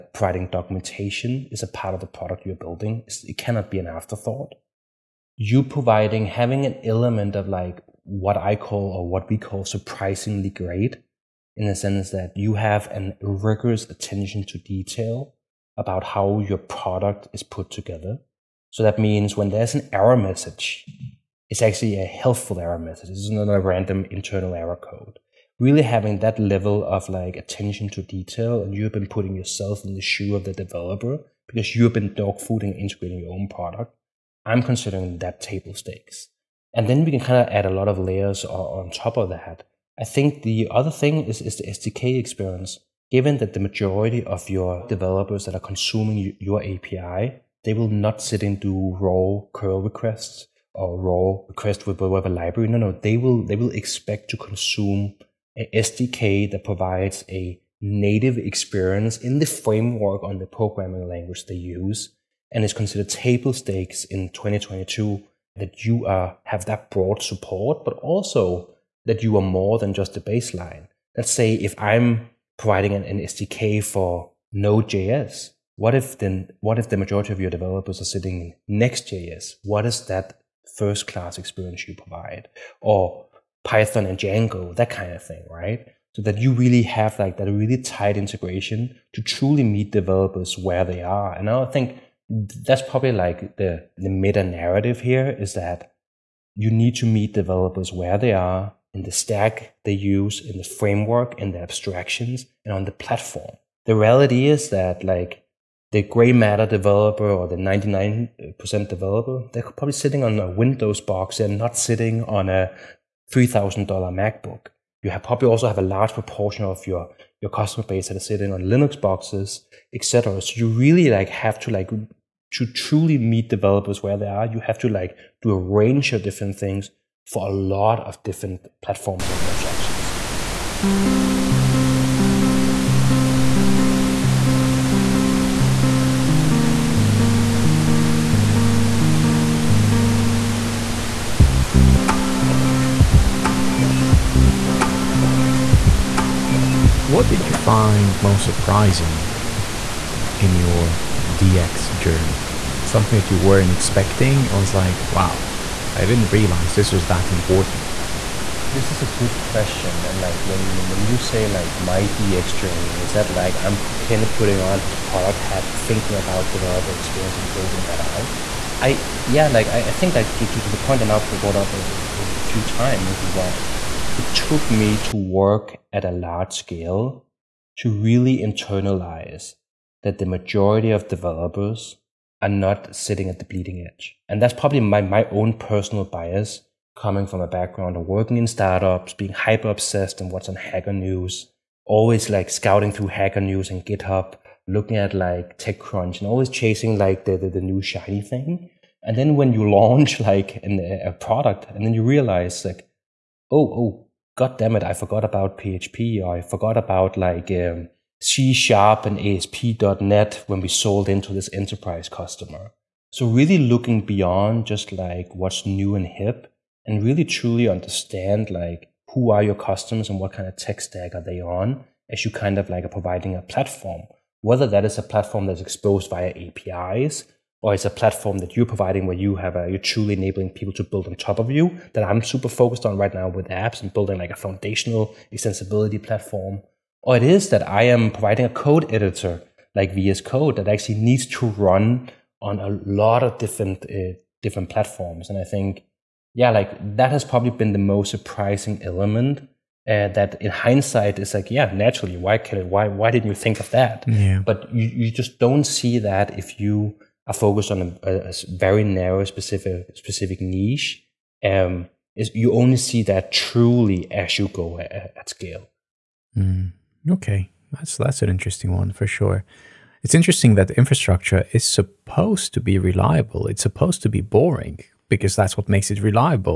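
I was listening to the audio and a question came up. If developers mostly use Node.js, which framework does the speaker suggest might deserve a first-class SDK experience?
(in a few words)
Next.js.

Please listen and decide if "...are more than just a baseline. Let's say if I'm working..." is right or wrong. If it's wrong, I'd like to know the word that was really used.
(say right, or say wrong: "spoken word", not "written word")
wrong: "providing", not "working".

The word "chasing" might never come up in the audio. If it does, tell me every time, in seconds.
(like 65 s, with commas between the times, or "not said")
196 s.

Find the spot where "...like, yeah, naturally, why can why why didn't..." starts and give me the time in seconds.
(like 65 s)
251 s.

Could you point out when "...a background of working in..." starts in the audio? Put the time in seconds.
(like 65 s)
187 s.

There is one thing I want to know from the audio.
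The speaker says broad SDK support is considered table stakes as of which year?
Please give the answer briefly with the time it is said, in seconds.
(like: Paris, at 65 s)
2022, at 64 s.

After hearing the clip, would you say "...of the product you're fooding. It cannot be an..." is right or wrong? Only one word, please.
wrong.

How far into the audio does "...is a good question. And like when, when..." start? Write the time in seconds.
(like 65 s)
158 s.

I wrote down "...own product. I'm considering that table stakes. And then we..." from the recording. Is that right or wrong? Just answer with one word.
right.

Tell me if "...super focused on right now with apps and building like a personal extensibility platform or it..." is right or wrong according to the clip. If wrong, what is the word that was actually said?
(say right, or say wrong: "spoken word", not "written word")
wrong: "foundational", not "personal".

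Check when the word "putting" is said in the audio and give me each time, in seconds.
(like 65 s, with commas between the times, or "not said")
29 s, 164 s.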